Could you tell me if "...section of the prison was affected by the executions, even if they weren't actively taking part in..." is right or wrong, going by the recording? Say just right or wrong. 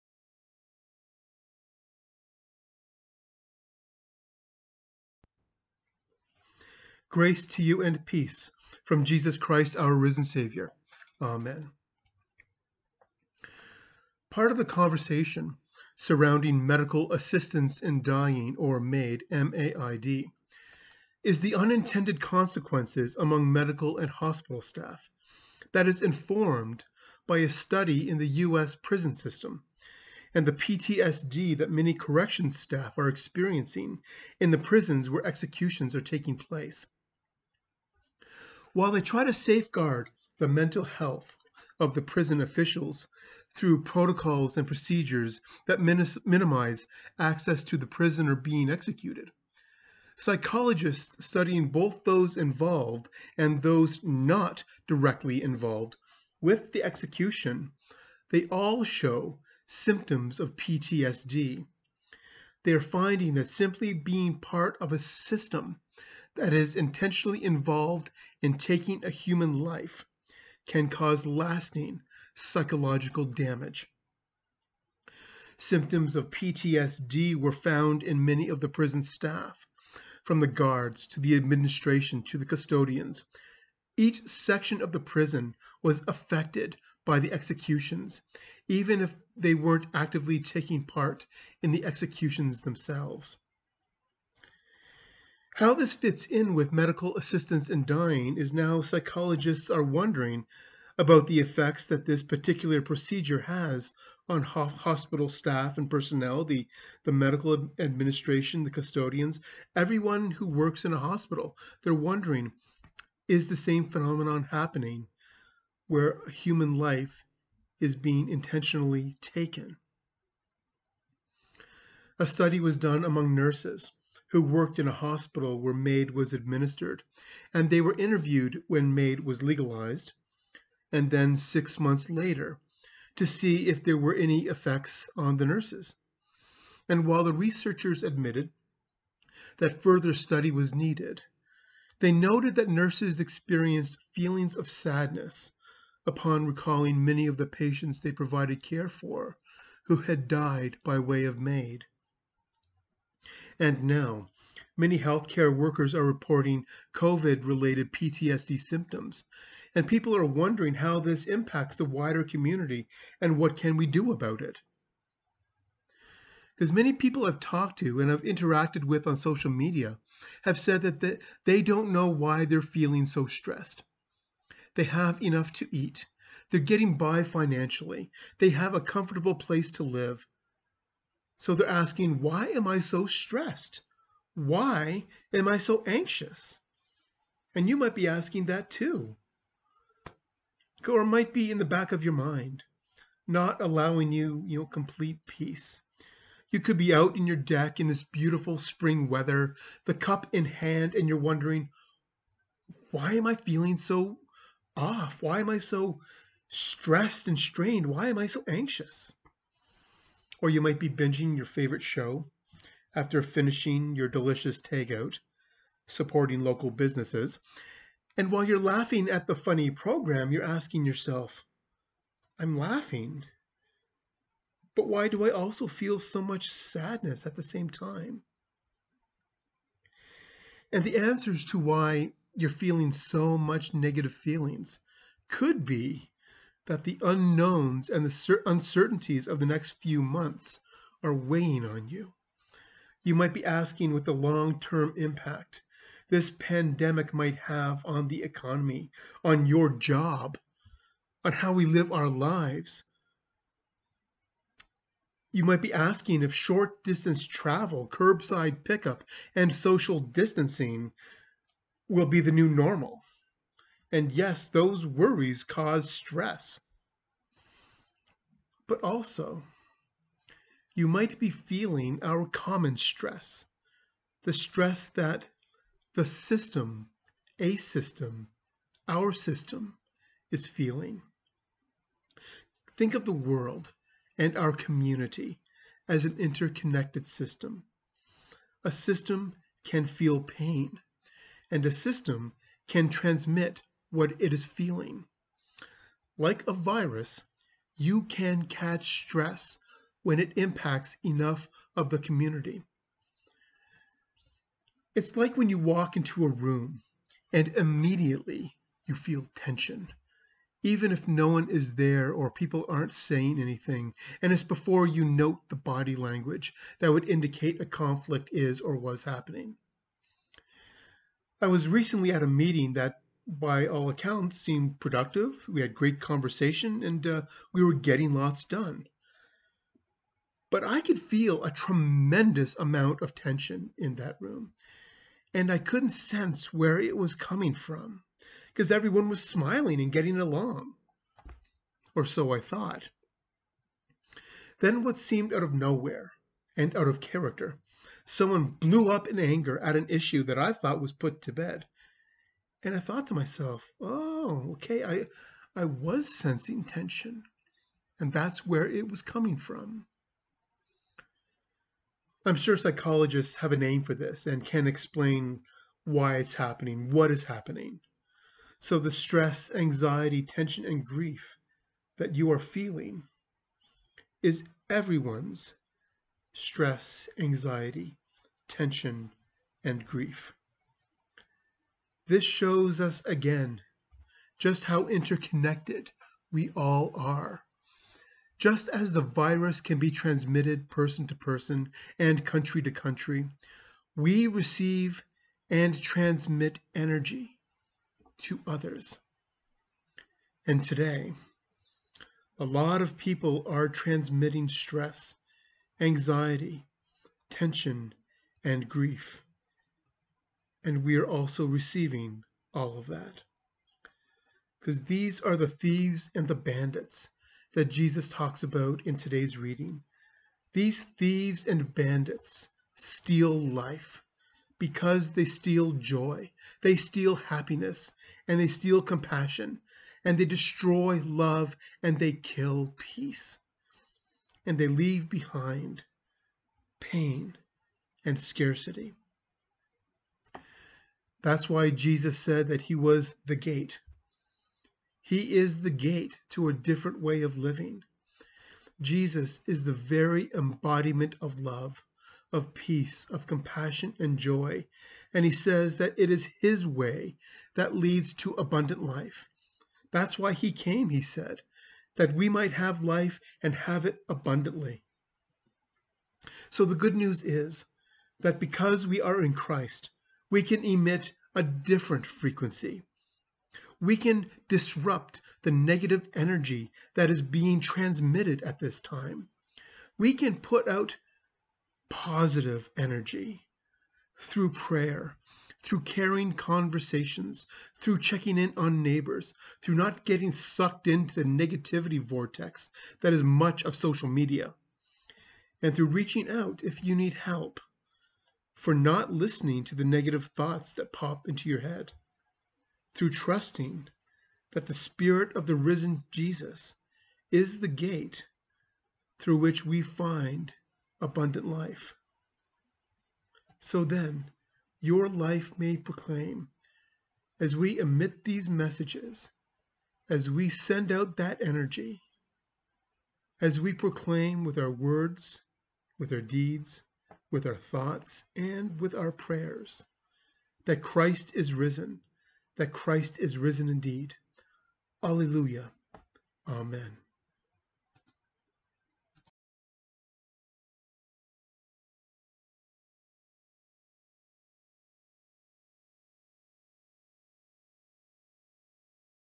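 right.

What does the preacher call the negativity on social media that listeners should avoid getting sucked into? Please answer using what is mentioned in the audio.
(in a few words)
negativity vortex.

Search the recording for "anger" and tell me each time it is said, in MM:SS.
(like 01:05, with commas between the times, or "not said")
05:49.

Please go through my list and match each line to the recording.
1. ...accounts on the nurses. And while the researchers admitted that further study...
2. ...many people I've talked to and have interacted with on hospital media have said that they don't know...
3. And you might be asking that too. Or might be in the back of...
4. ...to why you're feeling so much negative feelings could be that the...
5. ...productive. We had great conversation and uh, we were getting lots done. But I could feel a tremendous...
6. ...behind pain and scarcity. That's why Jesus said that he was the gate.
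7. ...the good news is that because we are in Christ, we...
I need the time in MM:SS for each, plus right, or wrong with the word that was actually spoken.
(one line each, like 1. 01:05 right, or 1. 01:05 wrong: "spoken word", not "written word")
1. 02:14 wrong: "effects", not "accounts"
2. 02:46 wrong: "social", not "hospital"
3. 03:07 right
4. 03:51 right
5. 05:24 right
6. 07:15 right
7. 07:46 right.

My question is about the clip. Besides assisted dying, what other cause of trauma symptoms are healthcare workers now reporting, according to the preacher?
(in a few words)
COVID.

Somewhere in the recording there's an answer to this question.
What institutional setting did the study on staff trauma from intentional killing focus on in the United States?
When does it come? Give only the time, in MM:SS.
00:28.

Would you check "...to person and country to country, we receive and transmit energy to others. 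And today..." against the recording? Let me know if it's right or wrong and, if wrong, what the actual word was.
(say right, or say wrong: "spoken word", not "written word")
right.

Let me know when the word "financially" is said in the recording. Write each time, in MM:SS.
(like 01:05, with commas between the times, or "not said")
02:57.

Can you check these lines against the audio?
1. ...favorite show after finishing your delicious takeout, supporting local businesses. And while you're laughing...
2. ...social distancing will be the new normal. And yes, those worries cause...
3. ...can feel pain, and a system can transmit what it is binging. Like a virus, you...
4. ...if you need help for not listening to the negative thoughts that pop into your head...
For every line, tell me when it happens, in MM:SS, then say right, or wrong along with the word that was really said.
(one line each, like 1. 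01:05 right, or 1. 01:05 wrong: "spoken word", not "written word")
1. 03:31 right
2. 04:19 right
3. 04:49 wrong: "feeling", not "binging"
4. 08:16 right.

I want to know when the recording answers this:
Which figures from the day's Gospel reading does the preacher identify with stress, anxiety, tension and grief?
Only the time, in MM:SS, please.
07:00.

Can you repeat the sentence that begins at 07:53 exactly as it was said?
We can disrupt the negative energy that is being transmitted at this time.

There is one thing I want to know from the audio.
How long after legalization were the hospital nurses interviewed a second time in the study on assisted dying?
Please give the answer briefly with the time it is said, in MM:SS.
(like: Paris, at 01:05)
six months later, at 02:11.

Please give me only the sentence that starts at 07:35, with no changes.
And he says that it is his way that leads to abundant life.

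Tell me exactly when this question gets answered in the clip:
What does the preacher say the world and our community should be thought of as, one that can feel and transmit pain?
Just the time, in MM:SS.
04:46.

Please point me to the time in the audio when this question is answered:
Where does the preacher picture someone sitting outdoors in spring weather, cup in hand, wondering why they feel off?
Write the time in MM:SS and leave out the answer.
03:17.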